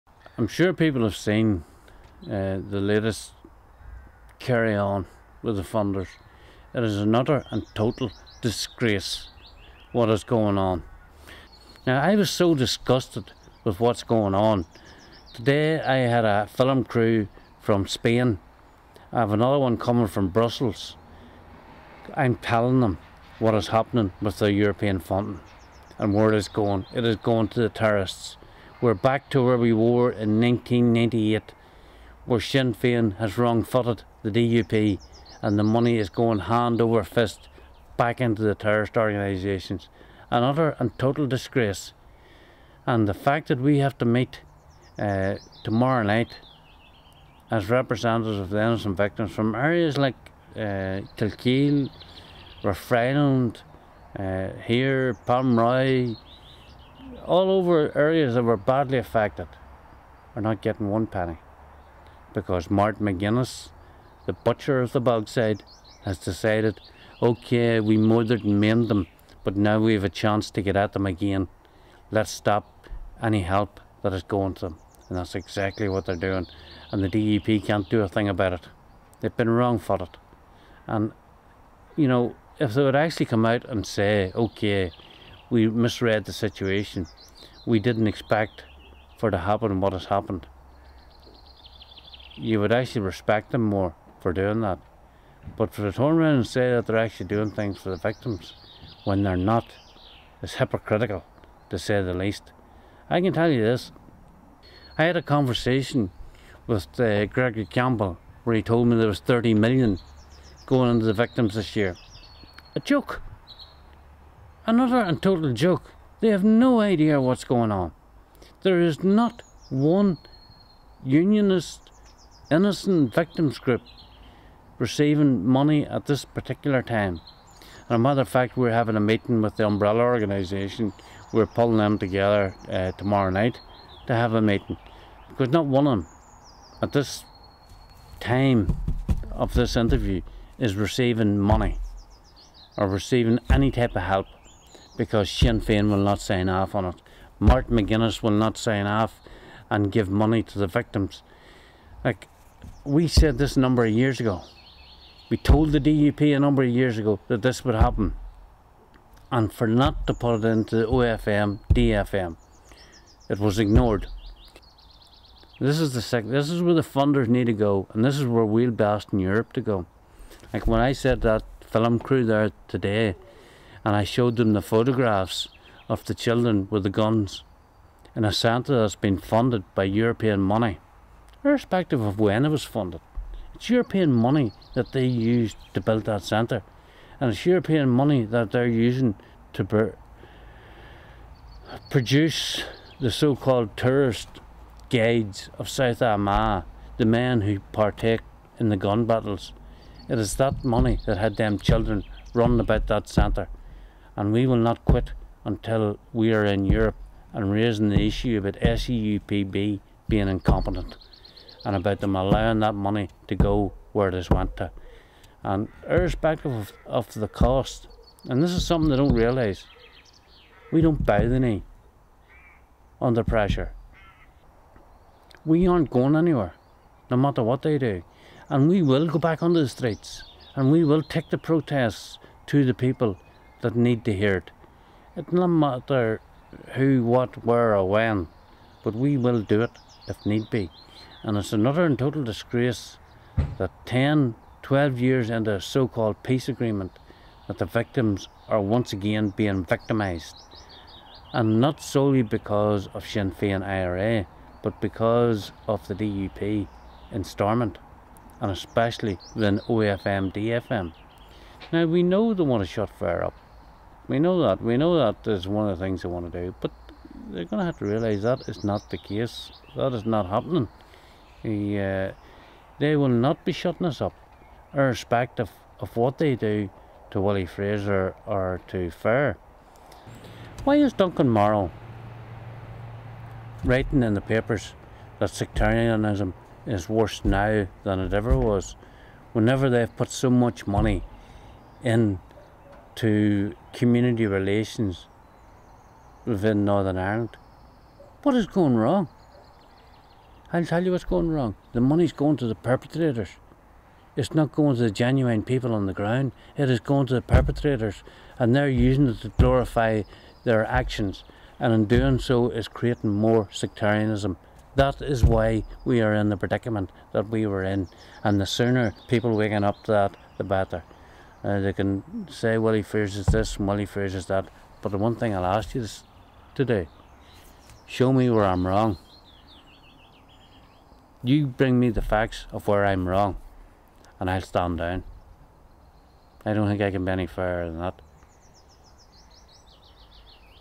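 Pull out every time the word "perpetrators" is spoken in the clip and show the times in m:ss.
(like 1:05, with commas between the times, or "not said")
5:02, 5:07.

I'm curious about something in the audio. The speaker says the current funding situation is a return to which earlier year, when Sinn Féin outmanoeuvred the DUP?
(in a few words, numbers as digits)
1998.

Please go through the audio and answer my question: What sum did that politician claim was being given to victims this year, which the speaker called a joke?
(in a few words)
30 million.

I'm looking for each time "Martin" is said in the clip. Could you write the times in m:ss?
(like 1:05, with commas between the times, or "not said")
1:02, 2:27.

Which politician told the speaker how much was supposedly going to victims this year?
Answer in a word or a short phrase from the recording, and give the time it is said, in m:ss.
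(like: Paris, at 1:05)
Gregory Campbell, at 1:47.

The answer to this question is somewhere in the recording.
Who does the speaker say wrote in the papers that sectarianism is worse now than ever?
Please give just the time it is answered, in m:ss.
4:40.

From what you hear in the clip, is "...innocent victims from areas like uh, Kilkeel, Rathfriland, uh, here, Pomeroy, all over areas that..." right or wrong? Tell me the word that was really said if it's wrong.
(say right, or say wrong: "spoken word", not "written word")
right.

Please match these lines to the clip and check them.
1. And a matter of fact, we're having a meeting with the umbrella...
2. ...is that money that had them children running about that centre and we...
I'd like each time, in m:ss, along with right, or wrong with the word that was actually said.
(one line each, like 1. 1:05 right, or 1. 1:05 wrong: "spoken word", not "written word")
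1. 2:07 right
2. 3:20 right.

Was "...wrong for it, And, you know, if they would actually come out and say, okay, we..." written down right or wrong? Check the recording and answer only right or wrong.
right.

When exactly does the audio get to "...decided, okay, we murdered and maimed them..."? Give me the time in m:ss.
1:06.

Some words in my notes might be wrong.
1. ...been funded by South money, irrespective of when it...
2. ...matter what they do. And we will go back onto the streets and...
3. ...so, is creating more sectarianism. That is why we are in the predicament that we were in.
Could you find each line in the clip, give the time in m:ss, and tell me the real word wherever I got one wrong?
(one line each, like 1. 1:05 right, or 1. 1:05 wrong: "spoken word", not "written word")
1. 2:58 wrong: "European", not "South"
2. 3:47 right
3. 5:12 right.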